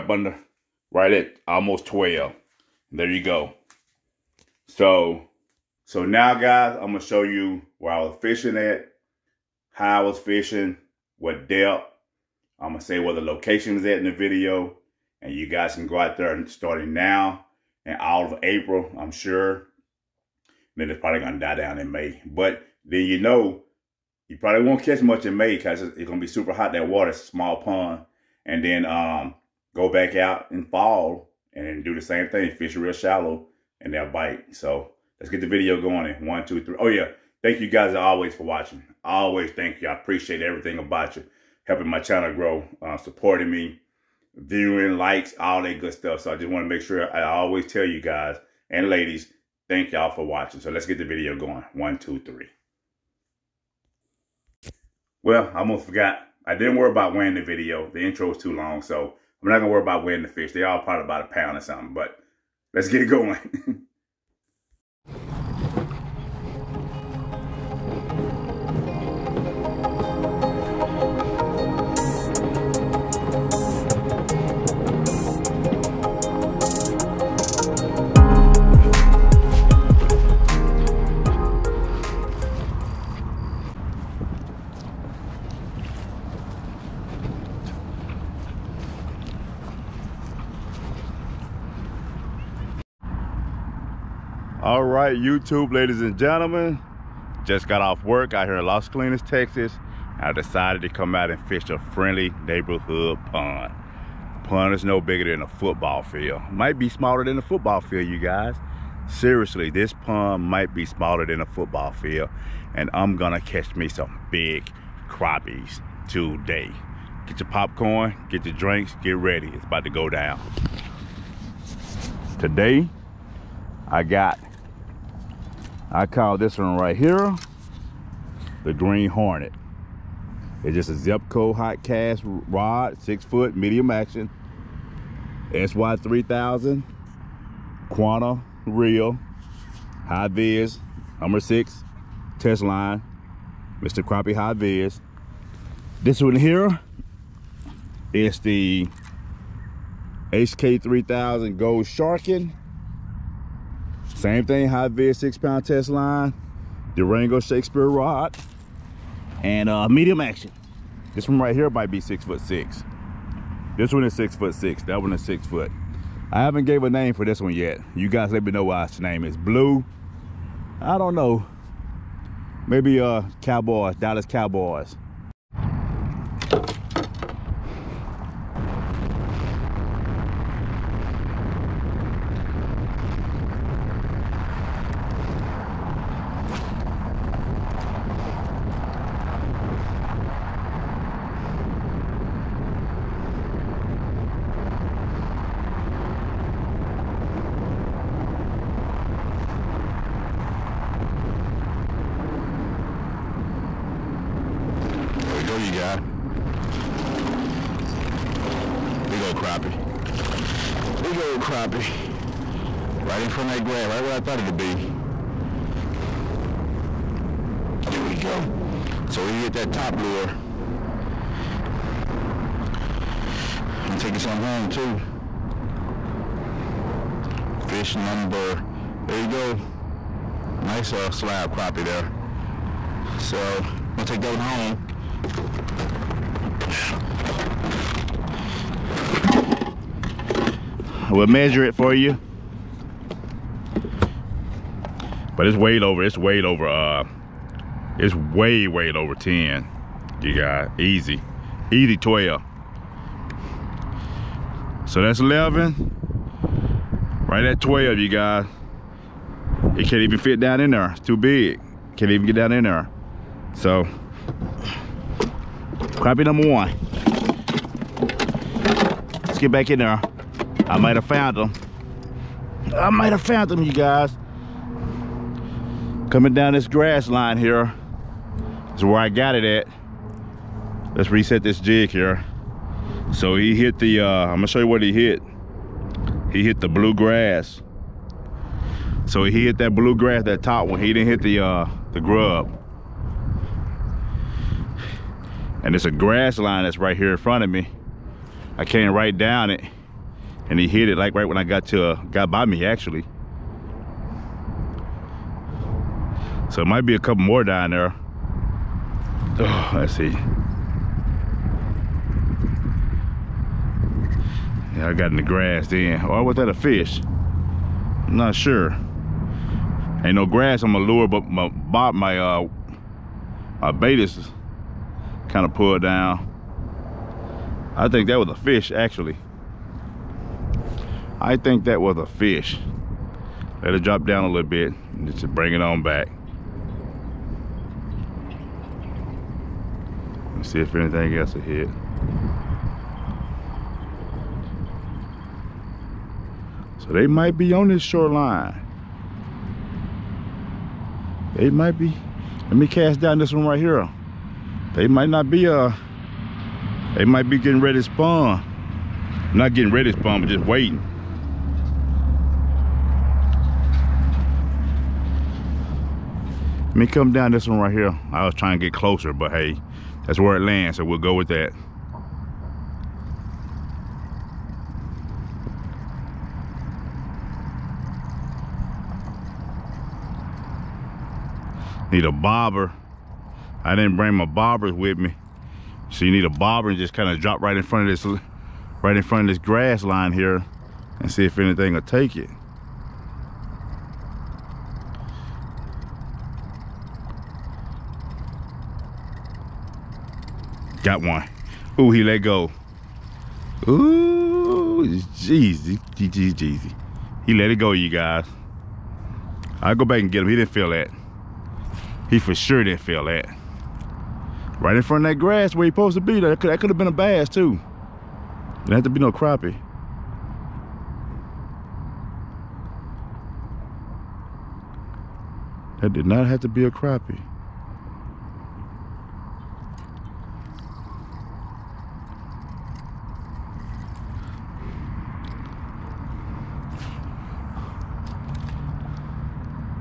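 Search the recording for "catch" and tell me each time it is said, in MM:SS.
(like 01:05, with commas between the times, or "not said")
00:24, 01:53.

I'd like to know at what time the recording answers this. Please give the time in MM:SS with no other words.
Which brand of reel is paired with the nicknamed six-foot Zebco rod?
02:17.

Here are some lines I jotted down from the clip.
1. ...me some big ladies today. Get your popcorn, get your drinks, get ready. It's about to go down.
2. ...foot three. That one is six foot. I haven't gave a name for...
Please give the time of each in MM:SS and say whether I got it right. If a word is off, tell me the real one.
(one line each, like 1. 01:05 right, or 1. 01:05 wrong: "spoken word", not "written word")
1. 01:53 wrong: "crappies", not "ladies"
2. 02:44 wrong: "six", not "three".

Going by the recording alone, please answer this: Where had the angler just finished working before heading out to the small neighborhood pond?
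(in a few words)
Las Colinas, Texas.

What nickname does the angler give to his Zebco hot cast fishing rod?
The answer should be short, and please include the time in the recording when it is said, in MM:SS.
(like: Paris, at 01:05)
Green Hornet, at 02:08.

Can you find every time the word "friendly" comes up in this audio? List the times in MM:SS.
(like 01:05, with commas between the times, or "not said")
01:41.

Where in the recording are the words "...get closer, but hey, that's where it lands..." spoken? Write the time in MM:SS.
06:08.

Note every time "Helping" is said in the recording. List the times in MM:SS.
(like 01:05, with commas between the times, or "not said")
00:41.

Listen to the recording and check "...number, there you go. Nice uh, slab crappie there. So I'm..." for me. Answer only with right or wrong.
right.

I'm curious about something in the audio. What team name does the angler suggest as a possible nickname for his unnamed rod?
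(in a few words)
Dallas Cowboys.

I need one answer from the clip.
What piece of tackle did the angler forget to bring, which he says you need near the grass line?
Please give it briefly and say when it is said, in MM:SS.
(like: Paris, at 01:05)
bobbers, at 06:24.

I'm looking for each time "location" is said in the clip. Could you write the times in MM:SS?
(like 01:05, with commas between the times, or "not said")
00:13.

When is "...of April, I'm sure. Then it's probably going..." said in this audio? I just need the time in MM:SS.
00:18.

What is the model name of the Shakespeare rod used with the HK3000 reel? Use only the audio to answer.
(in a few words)
Durango.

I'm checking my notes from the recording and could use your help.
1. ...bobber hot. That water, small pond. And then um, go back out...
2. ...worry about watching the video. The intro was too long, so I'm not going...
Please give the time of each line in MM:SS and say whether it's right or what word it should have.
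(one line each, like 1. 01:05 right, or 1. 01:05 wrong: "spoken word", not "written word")
1. 00:26 wrong: "super", not "bobber"
2. 00:56 wrong: "wearing", not "watching".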